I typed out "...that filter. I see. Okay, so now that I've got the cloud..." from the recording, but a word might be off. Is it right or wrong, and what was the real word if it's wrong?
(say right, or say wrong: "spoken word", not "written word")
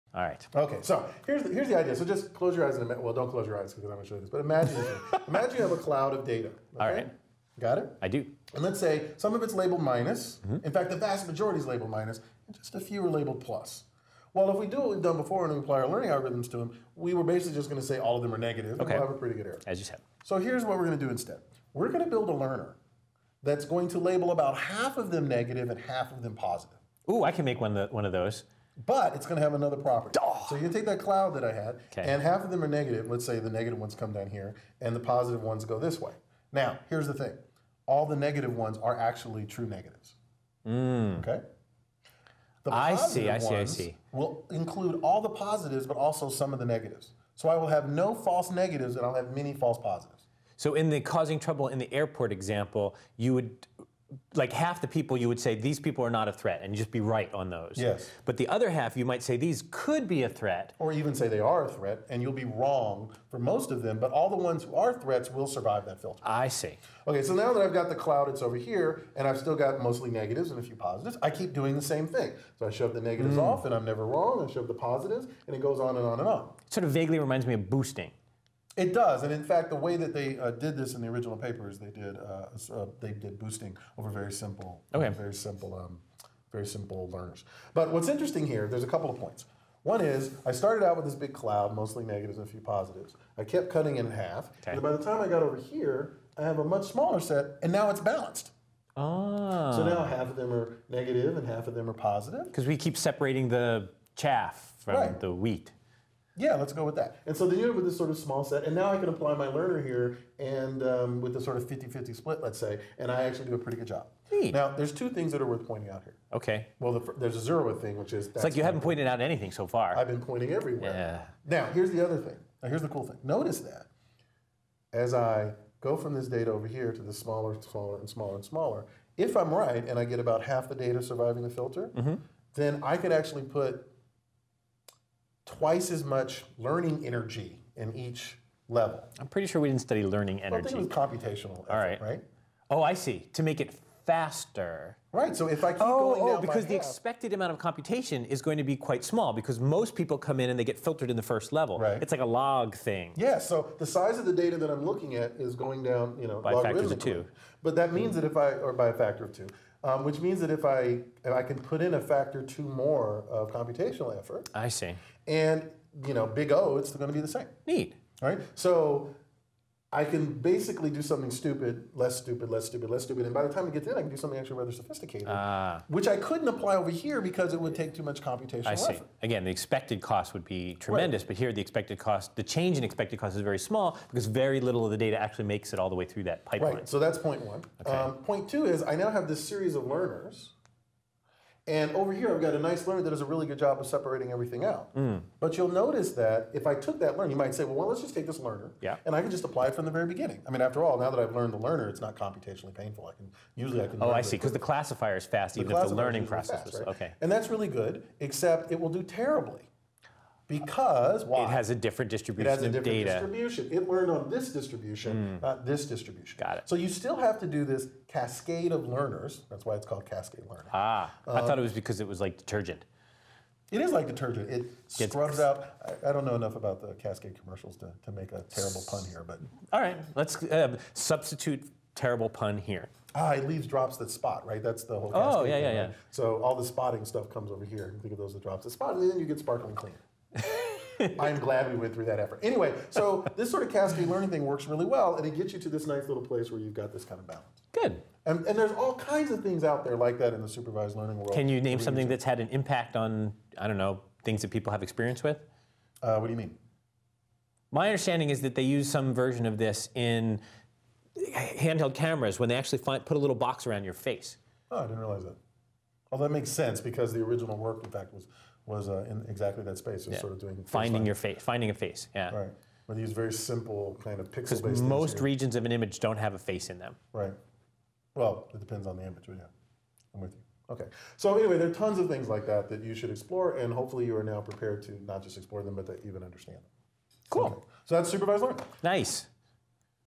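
right.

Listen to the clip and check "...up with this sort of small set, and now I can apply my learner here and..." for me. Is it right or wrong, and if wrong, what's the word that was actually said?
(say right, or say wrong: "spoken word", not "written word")
right.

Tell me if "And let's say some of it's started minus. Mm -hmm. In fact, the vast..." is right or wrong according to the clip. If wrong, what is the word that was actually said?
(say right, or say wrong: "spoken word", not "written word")
wrong: "labeled", not "started".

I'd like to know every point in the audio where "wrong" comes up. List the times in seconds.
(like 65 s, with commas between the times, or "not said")
62 s, 74 s.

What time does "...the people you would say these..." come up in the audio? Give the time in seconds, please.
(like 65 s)
54 s.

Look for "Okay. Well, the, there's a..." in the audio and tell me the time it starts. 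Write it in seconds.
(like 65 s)
116 s.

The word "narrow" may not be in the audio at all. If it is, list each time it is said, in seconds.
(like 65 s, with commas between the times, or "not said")
not said.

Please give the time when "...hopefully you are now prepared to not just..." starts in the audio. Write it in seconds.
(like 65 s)
283 s.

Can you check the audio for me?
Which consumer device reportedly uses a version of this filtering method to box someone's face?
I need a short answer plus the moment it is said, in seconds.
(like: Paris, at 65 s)
handheld cameras, at 261 s.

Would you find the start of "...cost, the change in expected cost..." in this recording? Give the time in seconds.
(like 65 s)
181 s.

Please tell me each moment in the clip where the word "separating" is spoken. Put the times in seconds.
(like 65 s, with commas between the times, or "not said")
102 s, 193 s.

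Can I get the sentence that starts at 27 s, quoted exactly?
Ooh, I can make one, the, one of those but it's going to have another property.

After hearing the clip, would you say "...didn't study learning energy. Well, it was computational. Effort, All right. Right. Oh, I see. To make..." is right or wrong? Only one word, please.
right.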